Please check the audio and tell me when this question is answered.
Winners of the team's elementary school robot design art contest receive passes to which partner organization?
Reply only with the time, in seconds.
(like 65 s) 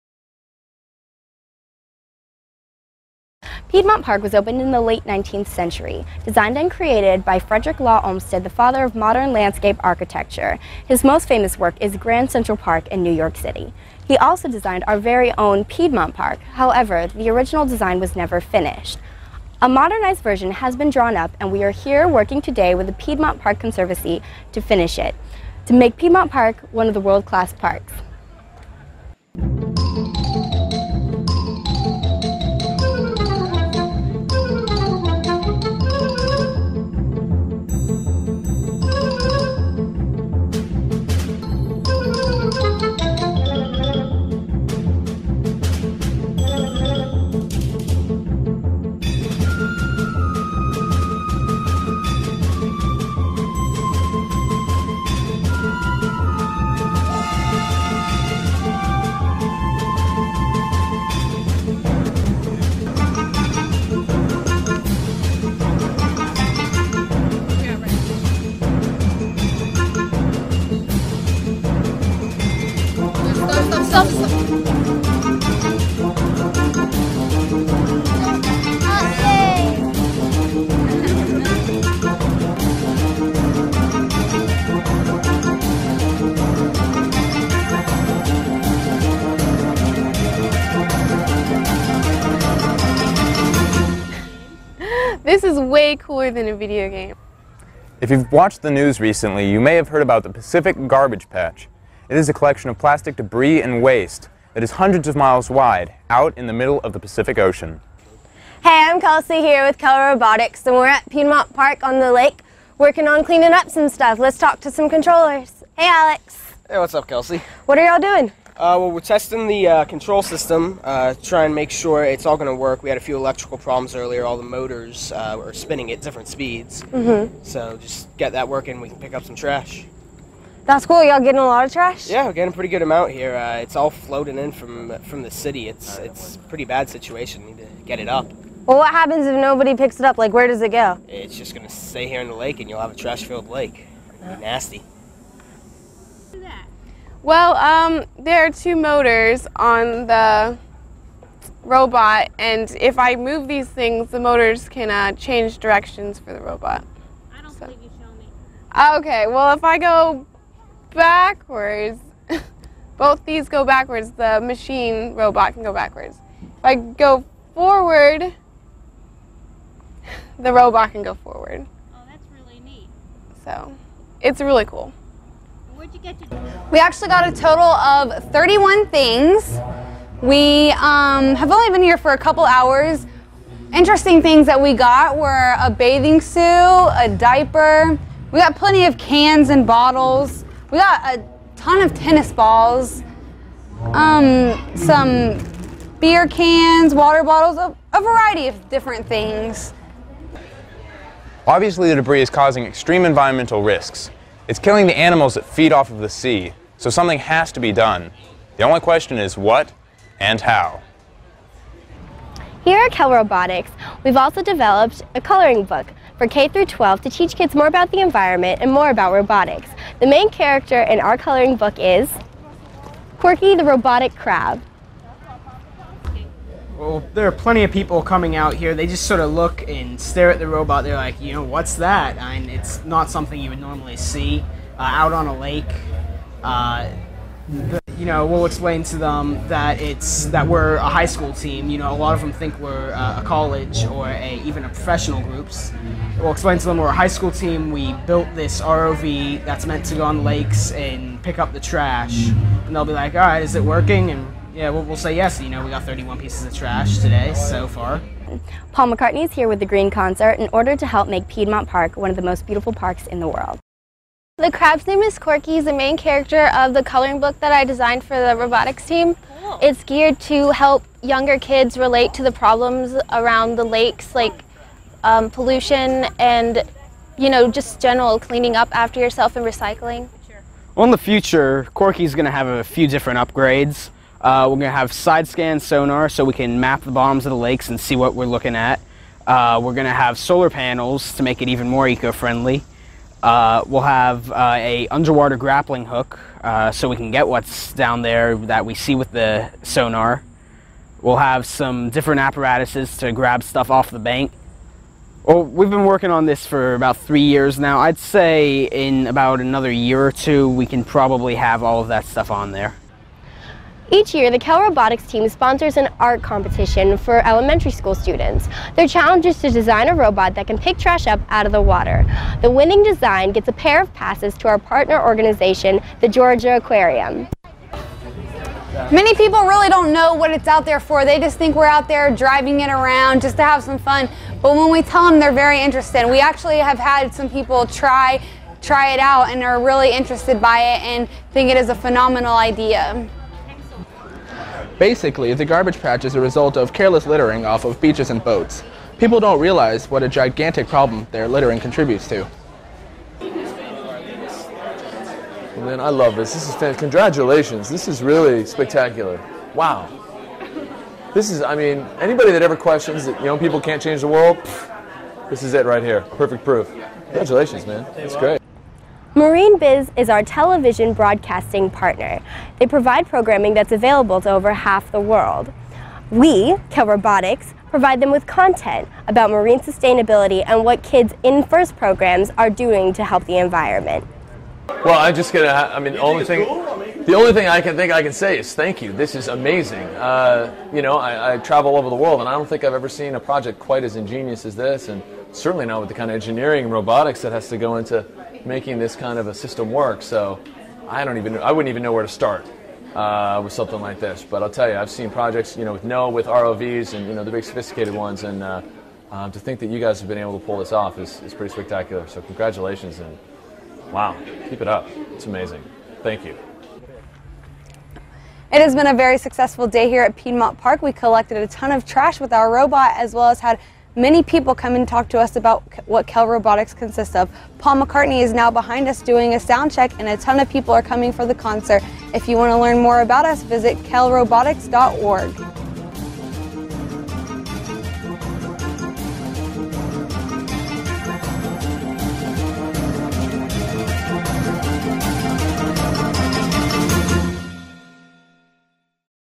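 326 s.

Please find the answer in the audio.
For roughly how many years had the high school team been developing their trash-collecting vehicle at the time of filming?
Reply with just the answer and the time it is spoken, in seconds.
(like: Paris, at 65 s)
3, at 306 s.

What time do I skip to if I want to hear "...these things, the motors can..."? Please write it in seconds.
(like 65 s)
153 s.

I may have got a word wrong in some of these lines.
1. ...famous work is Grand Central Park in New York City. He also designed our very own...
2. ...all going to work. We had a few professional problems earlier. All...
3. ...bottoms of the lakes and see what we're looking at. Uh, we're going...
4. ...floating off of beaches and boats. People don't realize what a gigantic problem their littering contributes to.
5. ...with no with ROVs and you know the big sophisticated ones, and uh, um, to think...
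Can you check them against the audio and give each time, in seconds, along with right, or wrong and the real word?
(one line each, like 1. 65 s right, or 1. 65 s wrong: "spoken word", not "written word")
1. 11 s right
2. 122 s wrong: "electrical", not "professional"
3. 286 s right
4. 347 s wrong: "littering", not "floating"
5. 405 s right.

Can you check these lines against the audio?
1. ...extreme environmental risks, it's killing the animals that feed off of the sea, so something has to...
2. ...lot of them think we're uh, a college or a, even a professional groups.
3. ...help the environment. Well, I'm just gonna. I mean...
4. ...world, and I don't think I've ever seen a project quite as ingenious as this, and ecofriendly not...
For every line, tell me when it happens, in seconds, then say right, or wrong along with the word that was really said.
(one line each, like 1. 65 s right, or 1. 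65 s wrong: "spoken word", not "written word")
1. 202 s right
2. 241 s right
3. 383 s right
4. 391 s wrong: "certainly", not "ecofriendly".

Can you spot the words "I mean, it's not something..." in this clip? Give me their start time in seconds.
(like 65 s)
232 s.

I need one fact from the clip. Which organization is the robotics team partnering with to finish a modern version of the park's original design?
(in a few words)
Piedmont Park Conservancy.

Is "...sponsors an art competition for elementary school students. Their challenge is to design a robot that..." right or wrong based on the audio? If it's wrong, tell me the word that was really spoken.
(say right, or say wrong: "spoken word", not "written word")
right.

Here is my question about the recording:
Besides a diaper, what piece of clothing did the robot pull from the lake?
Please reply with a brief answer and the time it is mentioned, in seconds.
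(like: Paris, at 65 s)
bathing suit, at 185 s.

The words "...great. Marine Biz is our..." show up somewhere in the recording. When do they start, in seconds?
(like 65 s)
368 s.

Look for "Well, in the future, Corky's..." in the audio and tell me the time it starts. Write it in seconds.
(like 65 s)
280 s.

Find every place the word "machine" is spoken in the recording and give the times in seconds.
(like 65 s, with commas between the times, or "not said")
164 s.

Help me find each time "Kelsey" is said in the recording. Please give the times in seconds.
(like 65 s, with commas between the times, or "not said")
109 s, 117 s.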